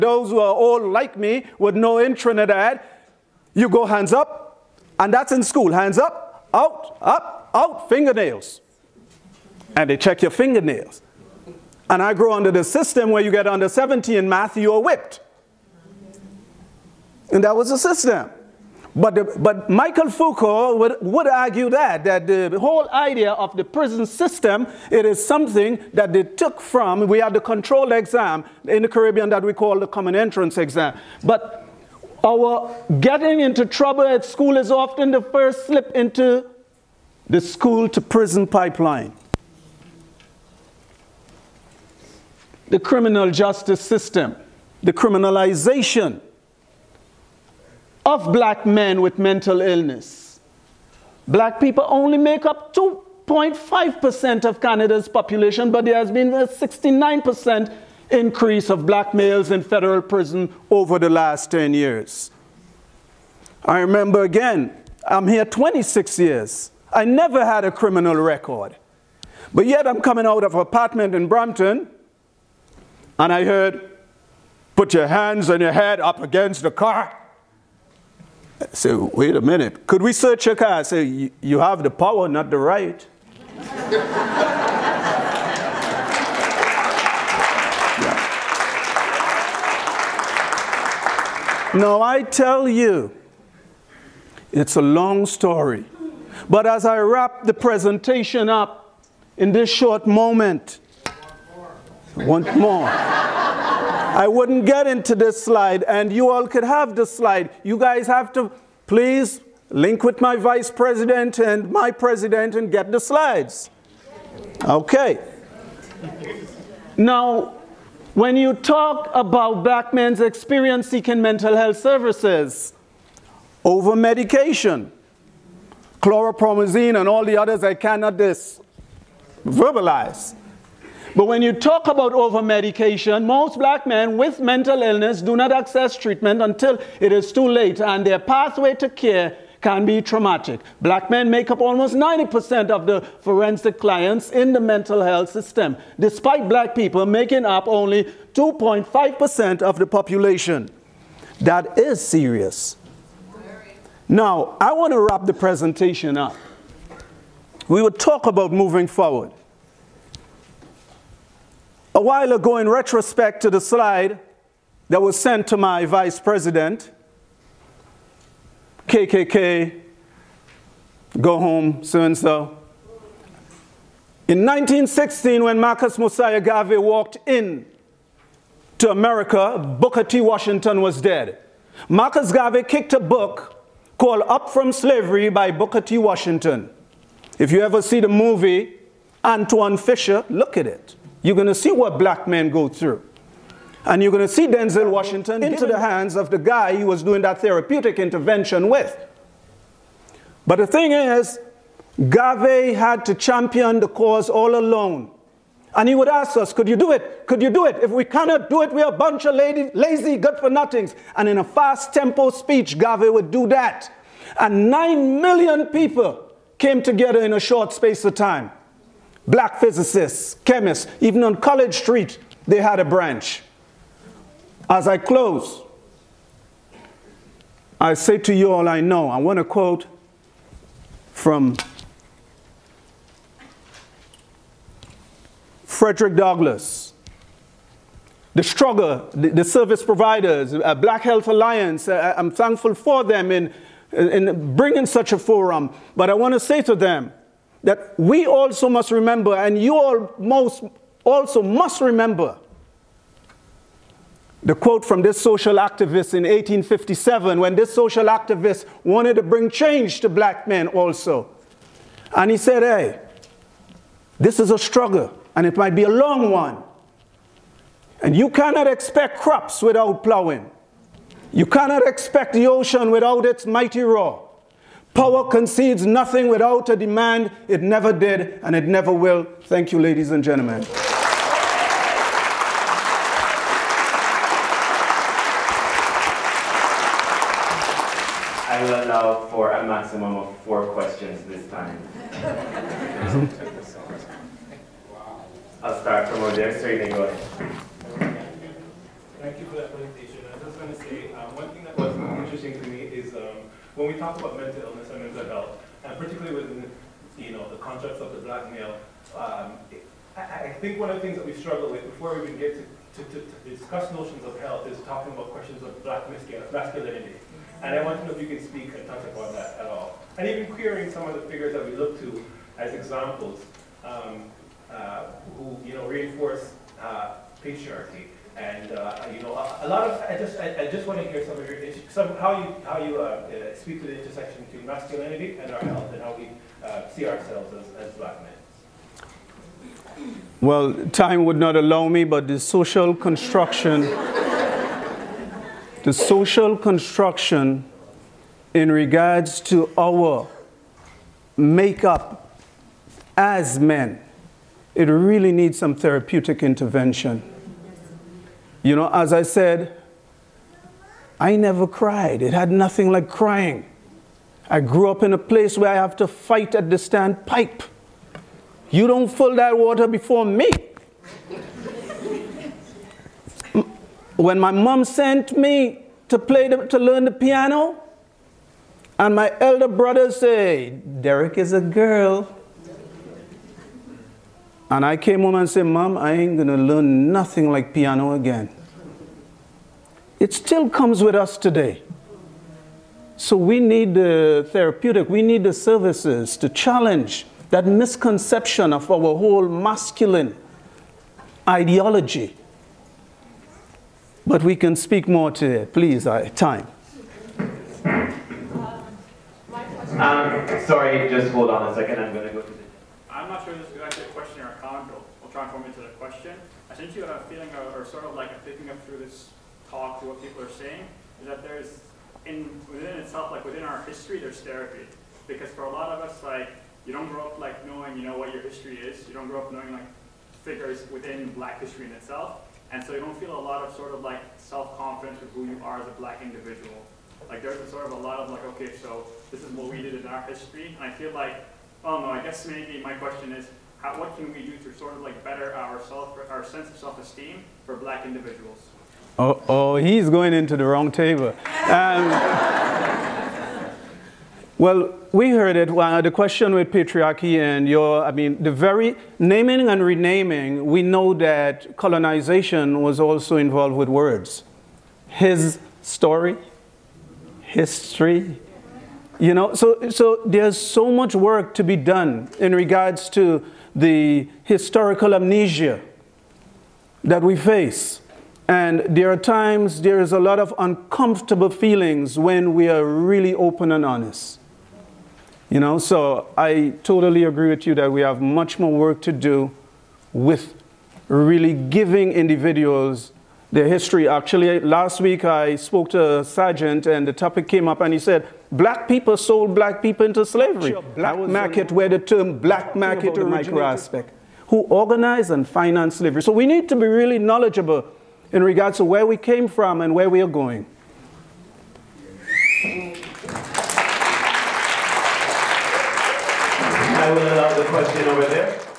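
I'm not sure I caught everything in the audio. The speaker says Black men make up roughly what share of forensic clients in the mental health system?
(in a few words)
almost 90%.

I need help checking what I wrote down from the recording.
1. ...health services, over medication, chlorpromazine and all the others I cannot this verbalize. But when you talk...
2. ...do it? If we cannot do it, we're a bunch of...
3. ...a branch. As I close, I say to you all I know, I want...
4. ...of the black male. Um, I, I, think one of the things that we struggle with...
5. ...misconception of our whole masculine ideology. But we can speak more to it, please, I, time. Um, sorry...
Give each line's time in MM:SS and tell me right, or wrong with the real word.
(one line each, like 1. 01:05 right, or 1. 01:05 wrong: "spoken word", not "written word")
1. 02:01 right
2. 03:27 right
3. 03:42 right
4. 05:08 right
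5. 06:37 right.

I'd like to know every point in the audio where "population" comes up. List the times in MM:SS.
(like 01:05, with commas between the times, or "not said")
00:55, 02:29.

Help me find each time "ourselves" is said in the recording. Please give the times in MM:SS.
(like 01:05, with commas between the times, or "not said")
05:37.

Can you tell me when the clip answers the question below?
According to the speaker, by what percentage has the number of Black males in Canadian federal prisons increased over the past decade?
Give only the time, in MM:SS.
00:56.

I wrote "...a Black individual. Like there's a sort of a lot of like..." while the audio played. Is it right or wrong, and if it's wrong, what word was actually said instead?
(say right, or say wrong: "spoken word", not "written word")
right.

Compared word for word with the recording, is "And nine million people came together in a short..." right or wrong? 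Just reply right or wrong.
right.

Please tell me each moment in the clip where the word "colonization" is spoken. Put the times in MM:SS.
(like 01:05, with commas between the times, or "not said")
07:41.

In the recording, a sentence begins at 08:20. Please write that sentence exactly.
Sure, black market, where the term black market micro Aspect, who organized and financed slavery.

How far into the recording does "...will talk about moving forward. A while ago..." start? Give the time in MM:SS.
02:37.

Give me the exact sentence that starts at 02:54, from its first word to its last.
In 1916, when Marcus Mosiah Garvey walked in to America, Booker T.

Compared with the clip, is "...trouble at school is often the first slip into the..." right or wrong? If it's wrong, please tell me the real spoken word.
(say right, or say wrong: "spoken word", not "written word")
right.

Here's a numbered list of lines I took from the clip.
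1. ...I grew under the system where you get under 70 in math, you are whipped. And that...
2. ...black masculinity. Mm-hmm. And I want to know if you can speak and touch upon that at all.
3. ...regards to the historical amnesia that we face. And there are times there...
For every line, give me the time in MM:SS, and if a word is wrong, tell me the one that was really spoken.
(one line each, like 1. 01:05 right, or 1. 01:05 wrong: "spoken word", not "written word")
1. 00:12 right
2. 05:15 right
3. 07:52 right.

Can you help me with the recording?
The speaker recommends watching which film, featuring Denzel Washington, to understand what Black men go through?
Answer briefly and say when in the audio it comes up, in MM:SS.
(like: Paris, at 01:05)
Antwone Fisher, at 03:09.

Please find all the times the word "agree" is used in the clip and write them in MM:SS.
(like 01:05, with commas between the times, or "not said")
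08:07.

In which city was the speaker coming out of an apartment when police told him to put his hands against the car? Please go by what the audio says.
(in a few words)
Brampton.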